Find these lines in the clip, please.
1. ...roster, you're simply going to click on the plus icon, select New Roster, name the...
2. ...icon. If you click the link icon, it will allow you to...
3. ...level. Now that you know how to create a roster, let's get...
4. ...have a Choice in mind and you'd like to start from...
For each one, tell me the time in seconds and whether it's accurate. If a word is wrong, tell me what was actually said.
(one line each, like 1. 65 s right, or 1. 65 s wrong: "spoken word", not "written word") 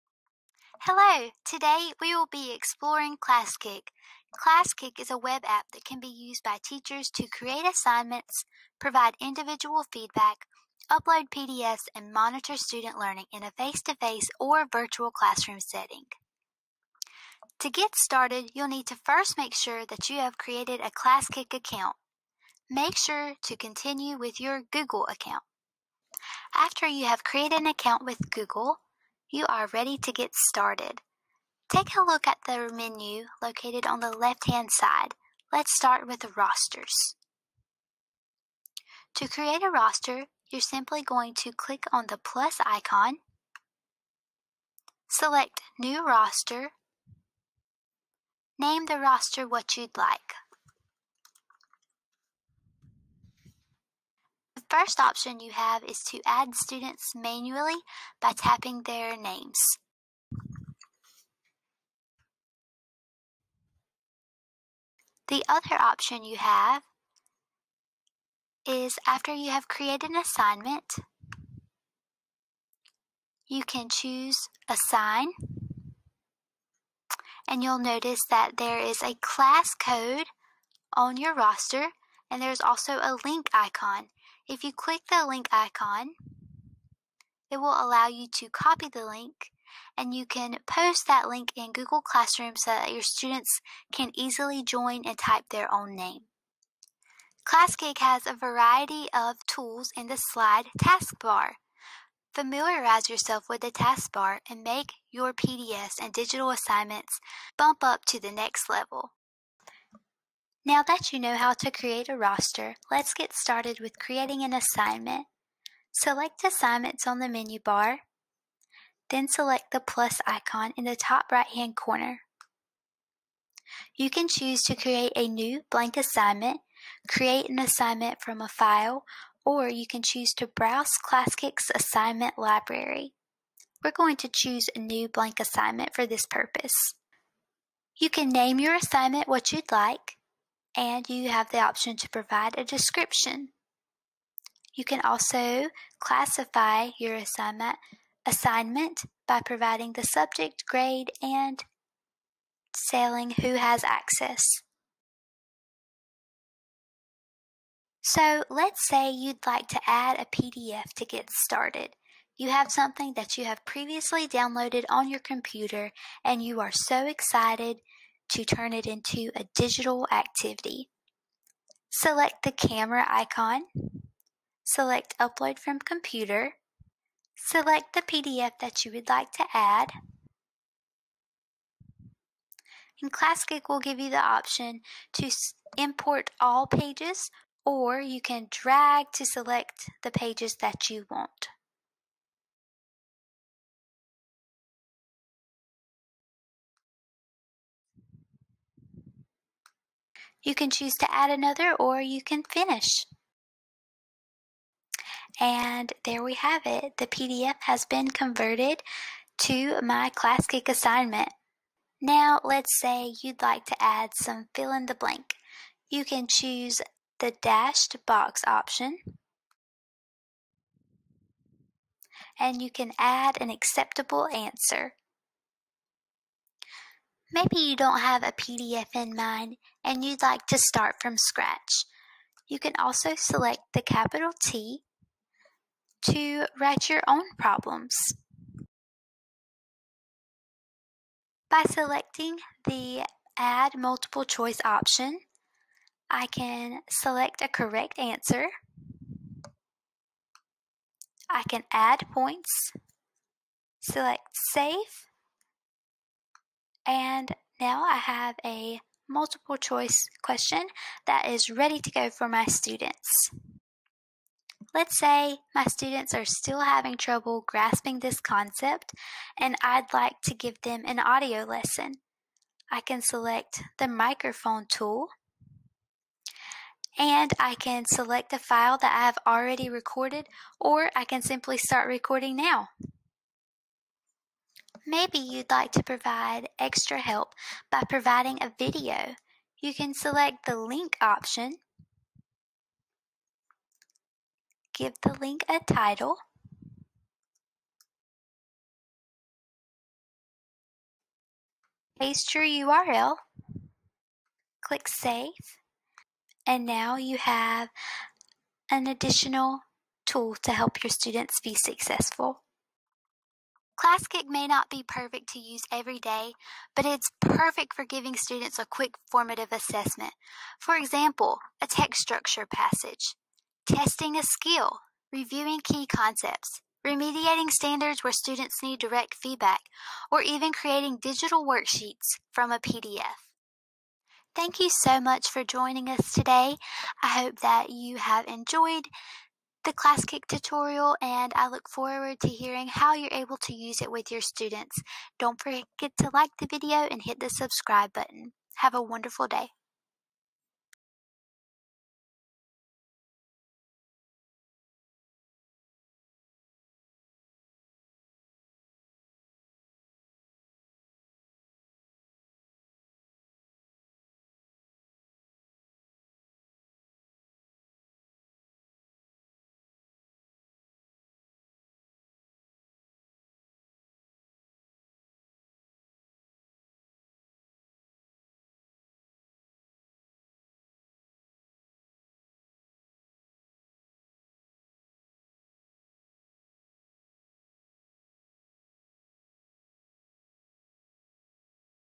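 1. 39 s right
2. 83 s right
3. 108 s right
4. 228 s wrong: "PDF", not "Choice".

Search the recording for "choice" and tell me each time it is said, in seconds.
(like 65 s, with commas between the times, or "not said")
244 s, 259 s.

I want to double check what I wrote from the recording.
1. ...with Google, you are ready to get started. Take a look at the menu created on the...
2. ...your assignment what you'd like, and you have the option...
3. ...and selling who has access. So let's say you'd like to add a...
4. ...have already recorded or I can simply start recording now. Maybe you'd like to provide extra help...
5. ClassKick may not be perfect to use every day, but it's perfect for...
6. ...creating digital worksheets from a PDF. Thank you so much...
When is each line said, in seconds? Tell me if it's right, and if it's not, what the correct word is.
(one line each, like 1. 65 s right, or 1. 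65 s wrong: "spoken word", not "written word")
1. 28 s wrong: "located", not "created"
2. 138 s right
3. 151 s right
4. 279 s right
5. 313 s right
6. 330 s right.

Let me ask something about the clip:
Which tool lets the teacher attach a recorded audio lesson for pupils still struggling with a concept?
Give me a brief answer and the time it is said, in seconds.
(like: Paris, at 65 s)
microphone tool, at 273 s.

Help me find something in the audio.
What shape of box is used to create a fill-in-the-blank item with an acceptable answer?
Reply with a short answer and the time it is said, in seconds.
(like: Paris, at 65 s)
dashed box, at 217 s.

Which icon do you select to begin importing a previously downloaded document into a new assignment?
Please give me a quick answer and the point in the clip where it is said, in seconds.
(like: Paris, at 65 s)
camera icon, at 172 s.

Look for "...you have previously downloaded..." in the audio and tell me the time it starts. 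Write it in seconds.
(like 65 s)
163 s.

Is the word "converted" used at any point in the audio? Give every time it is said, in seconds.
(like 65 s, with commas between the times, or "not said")
208 s.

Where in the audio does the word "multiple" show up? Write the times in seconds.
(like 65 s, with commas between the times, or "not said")
243 s, 259 s.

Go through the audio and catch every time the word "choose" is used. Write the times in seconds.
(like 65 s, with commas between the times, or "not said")
73 s, 124 s, 130 s, 134 s, 200 s, 216 s.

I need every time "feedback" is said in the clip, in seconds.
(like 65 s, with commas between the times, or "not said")
9 s, 329 s.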